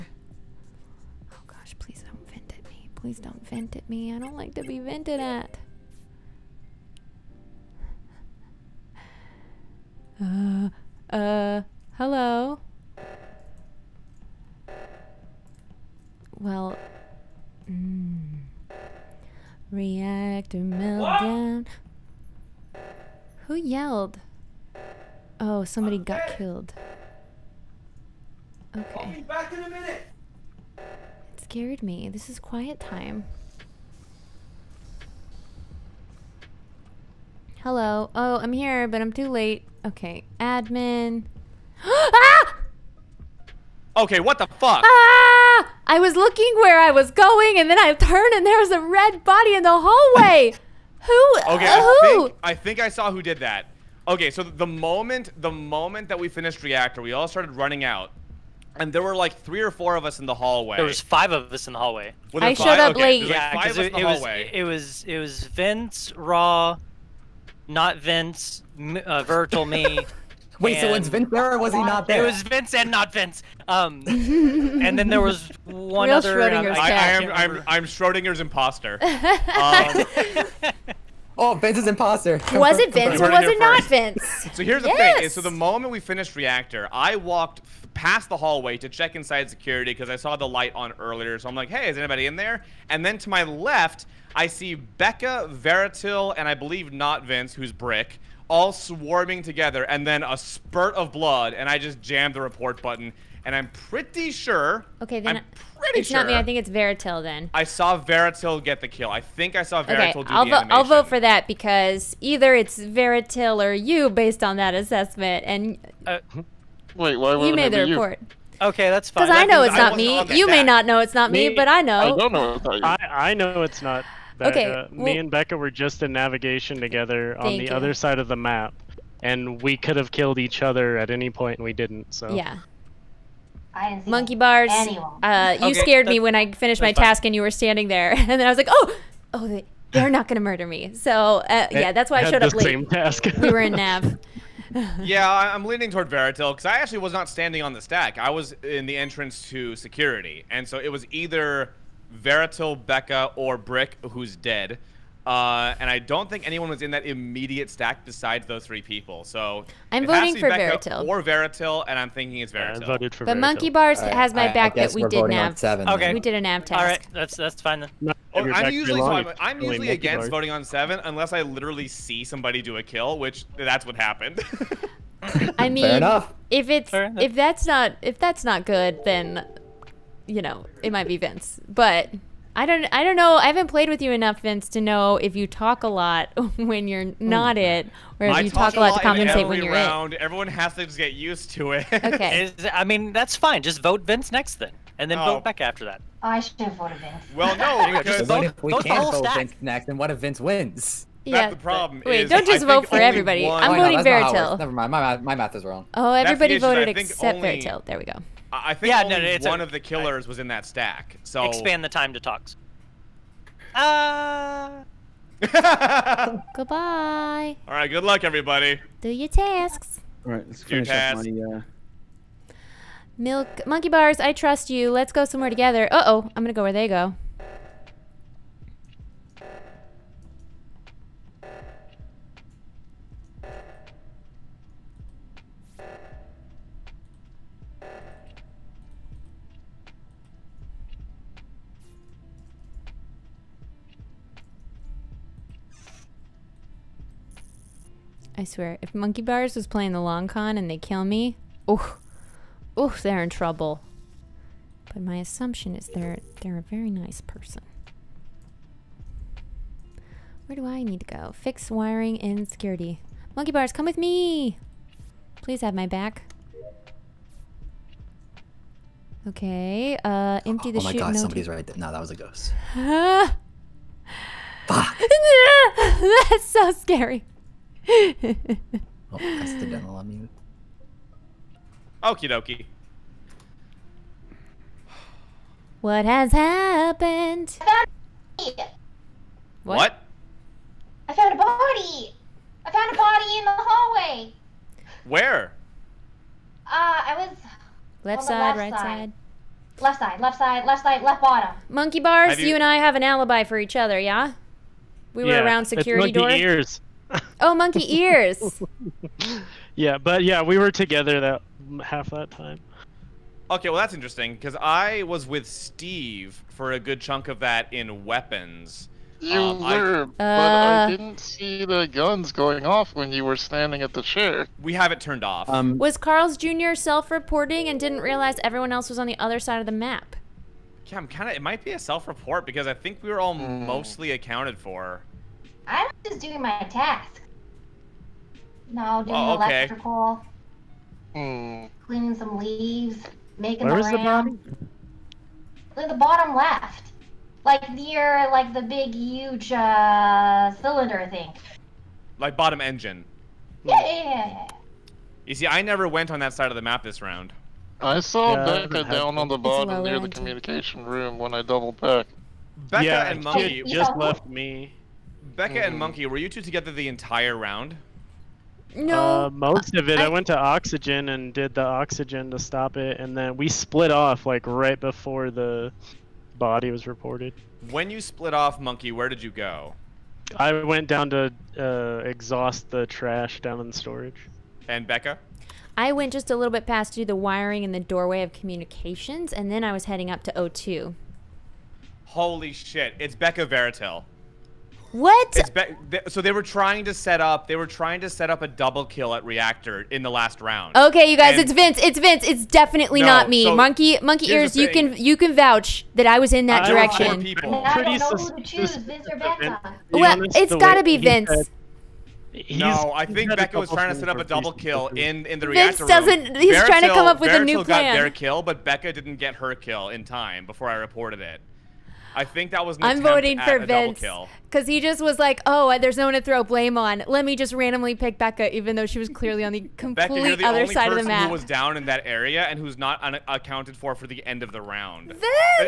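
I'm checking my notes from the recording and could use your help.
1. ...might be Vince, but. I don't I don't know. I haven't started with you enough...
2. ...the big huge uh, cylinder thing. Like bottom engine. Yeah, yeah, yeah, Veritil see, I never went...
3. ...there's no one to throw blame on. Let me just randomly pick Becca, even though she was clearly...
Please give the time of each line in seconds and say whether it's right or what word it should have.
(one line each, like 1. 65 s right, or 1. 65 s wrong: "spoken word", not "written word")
1. 180 s wrong: "played", not "started"
2. 348 s wrong: "You", not "Veritil"
3. 425 s right.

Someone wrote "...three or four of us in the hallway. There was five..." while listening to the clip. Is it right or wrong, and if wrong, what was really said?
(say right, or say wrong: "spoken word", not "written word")
right.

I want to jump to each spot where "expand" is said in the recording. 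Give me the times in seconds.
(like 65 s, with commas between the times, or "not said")
211 s.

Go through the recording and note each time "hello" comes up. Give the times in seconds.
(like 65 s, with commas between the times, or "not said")
11 s, 37 s.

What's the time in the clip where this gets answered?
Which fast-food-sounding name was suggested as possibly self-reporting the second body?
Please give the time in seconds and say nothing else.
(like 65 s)
325 s.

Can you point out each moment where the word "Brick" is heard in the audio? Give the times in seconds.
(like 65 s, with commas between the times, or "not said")
97 s, 153 s.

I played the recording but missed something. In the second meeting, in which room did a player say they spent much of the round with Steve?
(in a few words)
Weapons.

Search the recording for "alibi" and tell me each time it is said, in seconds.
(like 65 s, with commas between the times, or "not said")
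303 s.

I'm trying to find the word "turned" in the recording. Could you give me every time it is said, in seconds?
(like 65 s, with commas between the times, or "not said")
47 s, 324 s.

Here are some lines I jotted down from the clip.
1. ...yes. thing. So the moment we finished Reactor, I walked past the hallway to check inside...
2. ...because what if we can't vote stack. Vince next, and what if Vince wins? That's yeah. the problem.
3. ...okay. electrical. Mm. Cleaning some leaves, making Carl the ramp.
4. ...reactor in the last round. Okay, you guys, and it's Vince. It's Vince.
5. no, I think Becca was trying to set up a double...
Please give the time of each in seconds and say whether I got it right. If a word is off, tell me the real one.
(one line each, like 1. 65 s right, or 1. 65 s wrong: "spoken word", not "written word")
1. 84 s right
2. 197 s right
3. 339 s wrong: "Where", not "Carl"
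4. 399 s right
5. 412 s right.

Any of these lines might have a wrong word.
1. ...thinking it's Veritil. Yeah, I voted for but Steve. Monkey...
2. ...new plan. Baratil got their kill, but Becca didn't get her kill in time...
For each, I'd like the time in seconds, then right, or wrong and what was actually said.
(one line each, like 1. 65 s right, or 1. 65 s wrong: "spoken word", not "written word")
1. 162 s wrong: "Veritil", not "Steve"
2. 417 s right.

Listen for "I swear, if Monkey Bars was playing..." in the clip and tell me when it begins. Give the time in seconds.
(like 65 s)
248 s.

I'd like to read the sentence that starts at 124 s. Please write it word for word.
Okay, uh, well, me and Becca were just in navigation together on the you.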